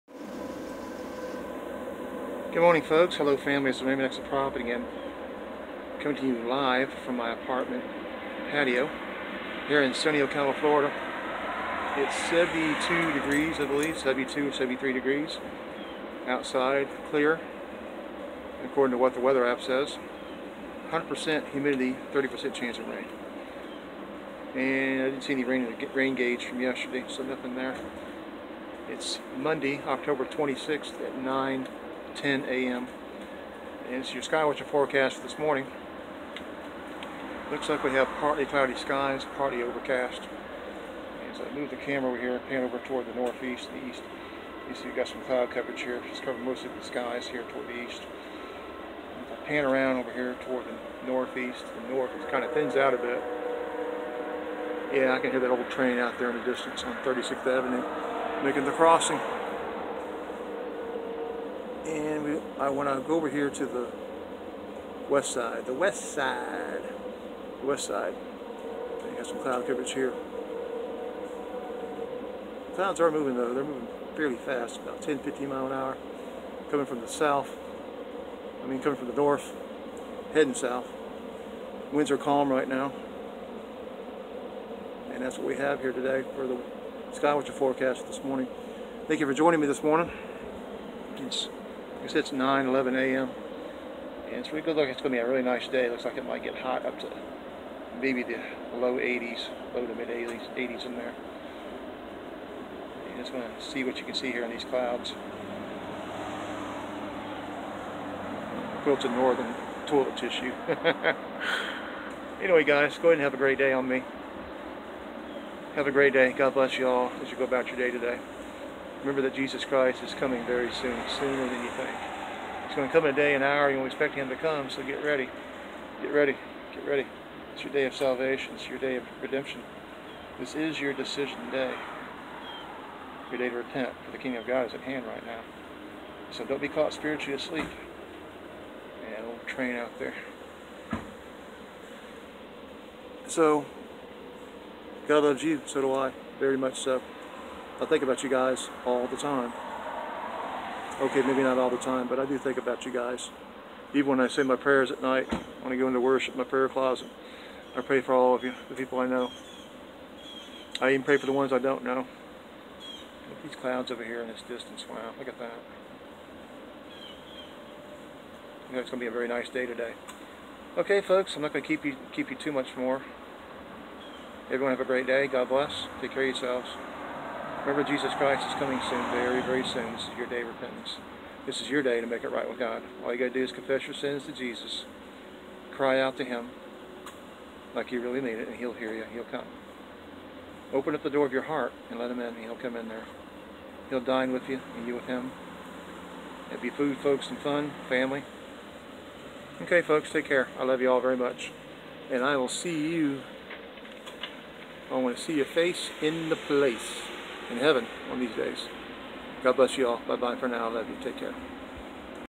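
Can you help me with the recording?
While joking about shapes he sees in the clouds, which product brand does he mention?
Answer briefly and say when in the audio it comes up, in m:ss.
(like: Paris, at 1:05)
Quilted Northern toilet tissue, at 1:48.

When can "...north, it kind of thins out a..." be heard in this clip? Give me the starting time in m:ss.
0:51.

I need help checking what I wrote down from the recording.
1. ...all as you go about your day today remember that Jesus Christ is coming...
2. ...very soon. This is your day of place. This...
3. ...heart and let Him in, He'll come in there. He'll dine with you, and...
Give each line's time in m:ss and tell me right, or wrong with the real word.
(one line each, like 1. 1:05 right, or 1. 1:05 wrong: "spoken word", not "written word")
1. 1:56 right
2. 2:59 wrong: "repentance", not "place"
3. 3:11 right.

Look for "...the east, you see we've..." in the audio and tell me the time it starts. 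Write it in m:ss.
0:43.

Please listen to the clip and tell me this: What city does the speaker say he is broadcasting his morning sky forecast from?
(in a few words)
Ocala, Florida.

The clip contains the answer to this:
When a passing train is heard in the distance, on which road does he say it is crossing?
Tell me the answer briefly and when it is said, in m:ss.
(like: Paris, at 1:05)
36th Avenue, at 0:56.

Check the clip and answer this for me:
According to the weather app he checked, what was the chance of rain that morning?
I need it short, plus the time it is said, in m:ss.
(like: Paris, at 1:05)
30%, at 0:22.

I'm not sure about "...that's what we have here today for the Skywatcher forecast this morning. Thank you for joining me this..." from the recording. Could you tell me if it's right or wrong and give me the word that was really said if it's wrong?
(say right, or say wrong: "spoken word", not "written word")
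right.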